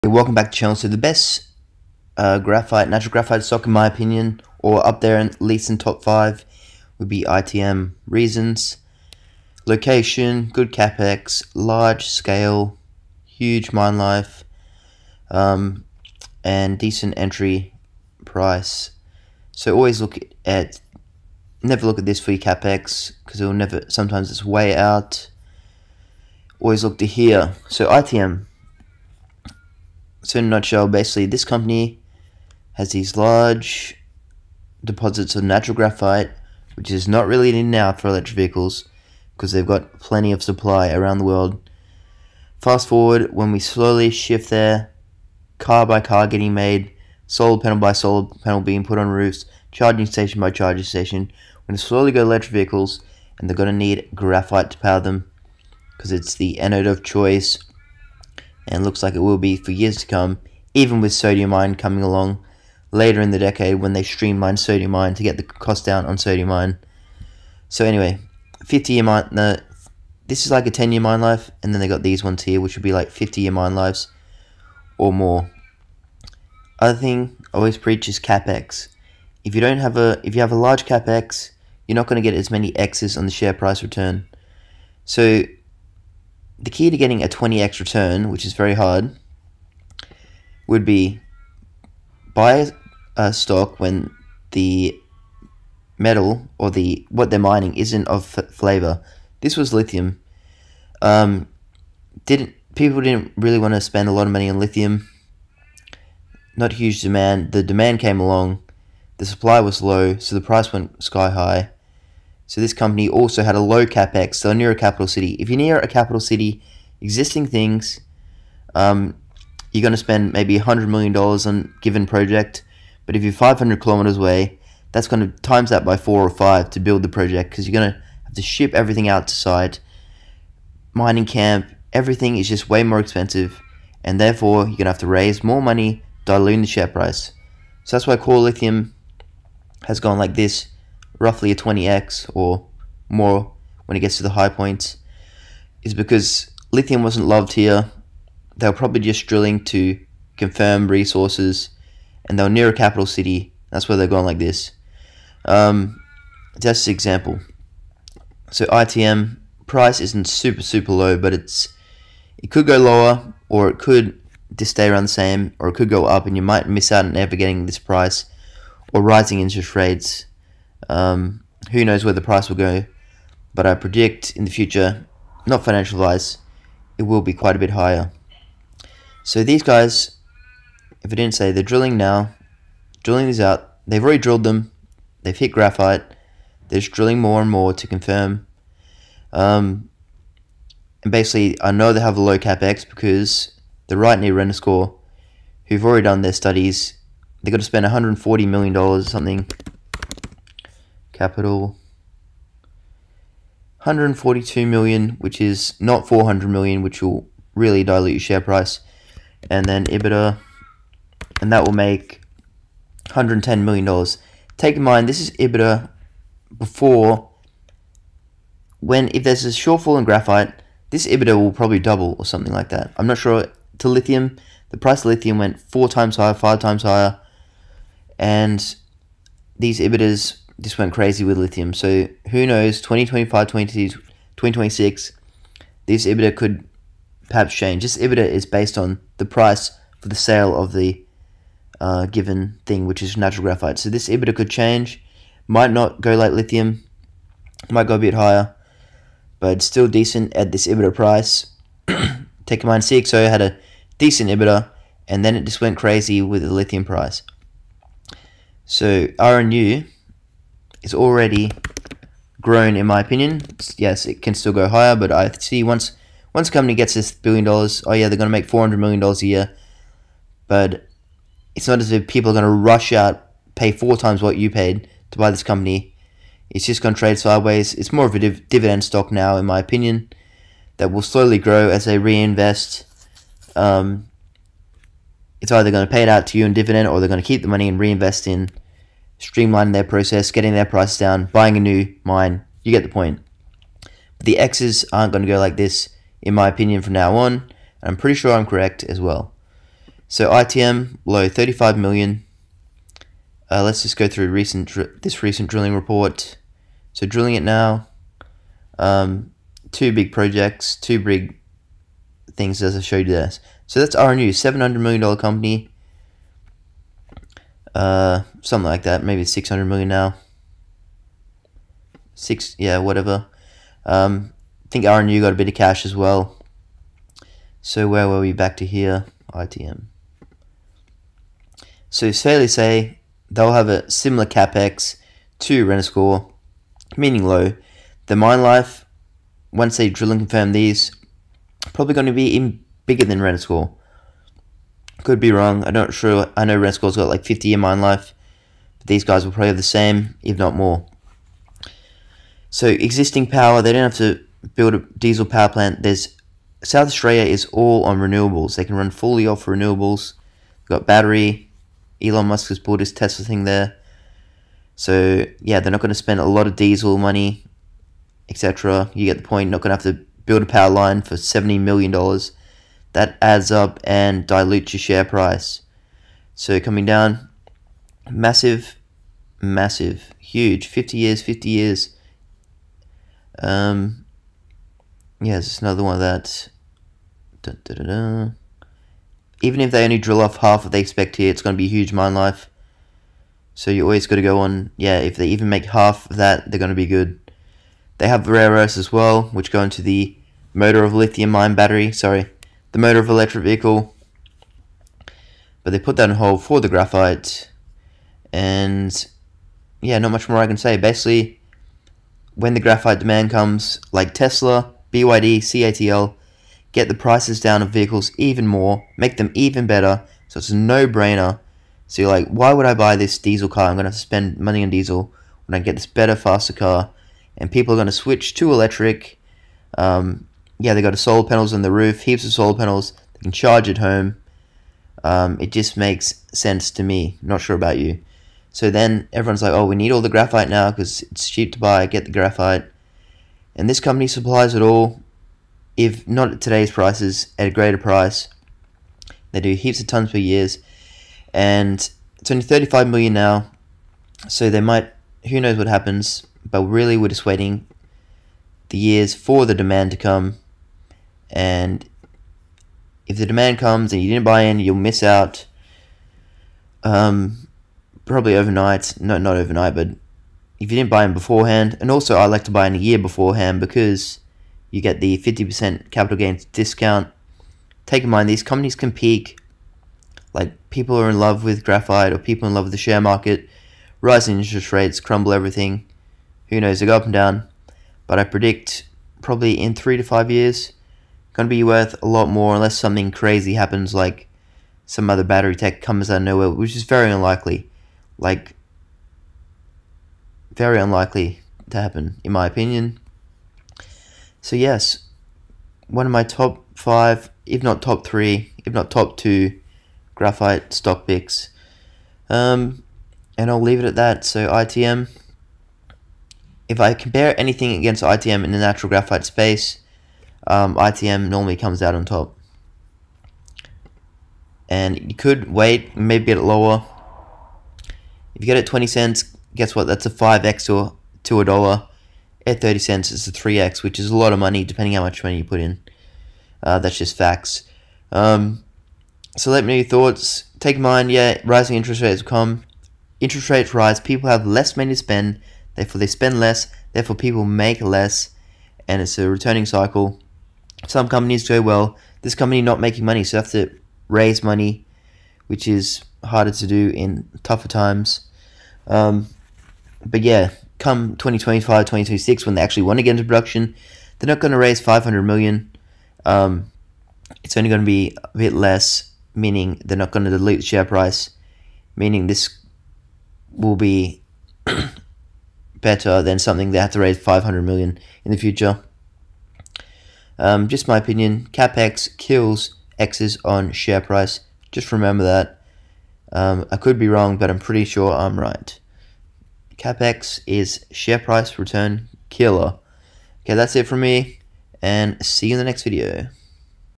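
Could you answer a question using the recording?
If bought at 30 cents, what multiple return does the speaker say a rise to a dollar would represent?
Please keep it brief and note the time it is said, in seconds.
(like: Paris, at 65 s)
3x, at 533 s.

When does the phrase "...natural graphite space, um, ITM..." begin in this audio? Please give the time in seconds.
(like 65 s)
518 s.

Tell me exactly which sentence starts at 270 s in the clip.
But it's not as if people are gonna rush out, pay four times what you paid to buy this company.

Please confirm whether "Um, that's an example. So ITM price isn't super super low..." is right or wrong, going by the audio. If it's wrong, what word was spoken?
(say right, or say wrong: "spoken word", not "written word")
right.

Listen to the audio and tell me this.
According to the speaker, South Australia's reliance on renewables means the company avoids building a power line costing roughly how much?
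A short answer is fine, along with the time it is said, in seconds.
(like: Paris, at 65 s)
$70 million, at 371 s.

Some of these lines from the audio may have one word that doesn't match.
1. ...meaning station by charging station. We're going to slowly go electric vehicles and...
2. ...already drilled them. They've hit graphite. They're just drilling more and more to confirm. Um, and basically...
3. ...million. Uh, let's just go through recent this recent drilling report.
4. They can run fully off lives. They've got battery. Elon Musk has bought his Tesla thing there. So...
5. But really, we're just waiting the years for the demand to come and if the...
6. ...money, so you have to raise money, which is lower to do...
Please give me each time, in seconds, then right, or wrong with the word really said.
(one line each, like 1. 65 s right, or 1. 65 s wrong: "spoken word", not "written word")
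1. 49 s wrong: "charging", not "meaning"
2. 184 s right
3. 301 s right
4. 358 s wrong: "renewables", not "lives"
5. 456 s right
6. 553 s wrong: "harder", not "lower".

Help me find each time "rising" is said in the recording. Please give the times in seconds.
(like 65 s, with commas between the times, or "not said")
169 s, 483 s, 541 s.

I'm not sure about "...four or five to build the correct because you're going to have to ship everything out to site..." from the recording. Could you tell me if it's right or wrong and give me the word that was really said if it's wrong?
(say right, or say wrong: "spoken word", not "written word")
wrong: "project", not "correct".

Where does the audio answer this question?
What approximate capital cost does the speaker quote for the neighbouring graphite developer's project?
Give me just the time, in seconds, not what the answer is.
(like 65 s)
203 s.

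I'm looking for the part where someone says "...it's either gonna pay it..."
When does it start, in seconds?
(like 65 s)
285 s.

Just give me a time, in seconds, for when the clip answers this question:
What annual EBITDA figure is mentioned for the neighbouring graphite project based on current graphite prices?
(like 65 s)
213 s.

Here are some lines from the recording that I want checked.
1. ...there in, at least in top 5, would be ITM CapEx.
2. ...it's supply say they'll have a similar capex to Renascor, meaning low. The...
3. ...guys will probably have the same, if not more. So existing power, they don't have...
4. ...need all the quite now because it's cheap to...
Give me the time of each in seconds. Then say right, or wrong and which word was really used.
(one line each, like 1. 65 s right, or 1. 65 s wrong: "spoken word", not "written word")
1. 5 s wrong: "Reasons", not "CapEx"
2. 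332 s wrong: "fairly", not "supply"
3. 349 s right
4. 439 s wrong: "graphite", not "quite".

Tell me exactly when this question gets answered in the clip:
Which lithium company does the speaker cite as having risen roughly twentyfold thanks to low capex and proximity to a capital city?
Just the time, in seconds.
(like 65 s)
138 s.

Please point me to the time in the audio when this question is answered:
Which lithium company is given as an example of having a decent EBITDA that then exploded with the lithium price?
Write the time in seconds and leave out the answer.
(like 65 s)
252 s.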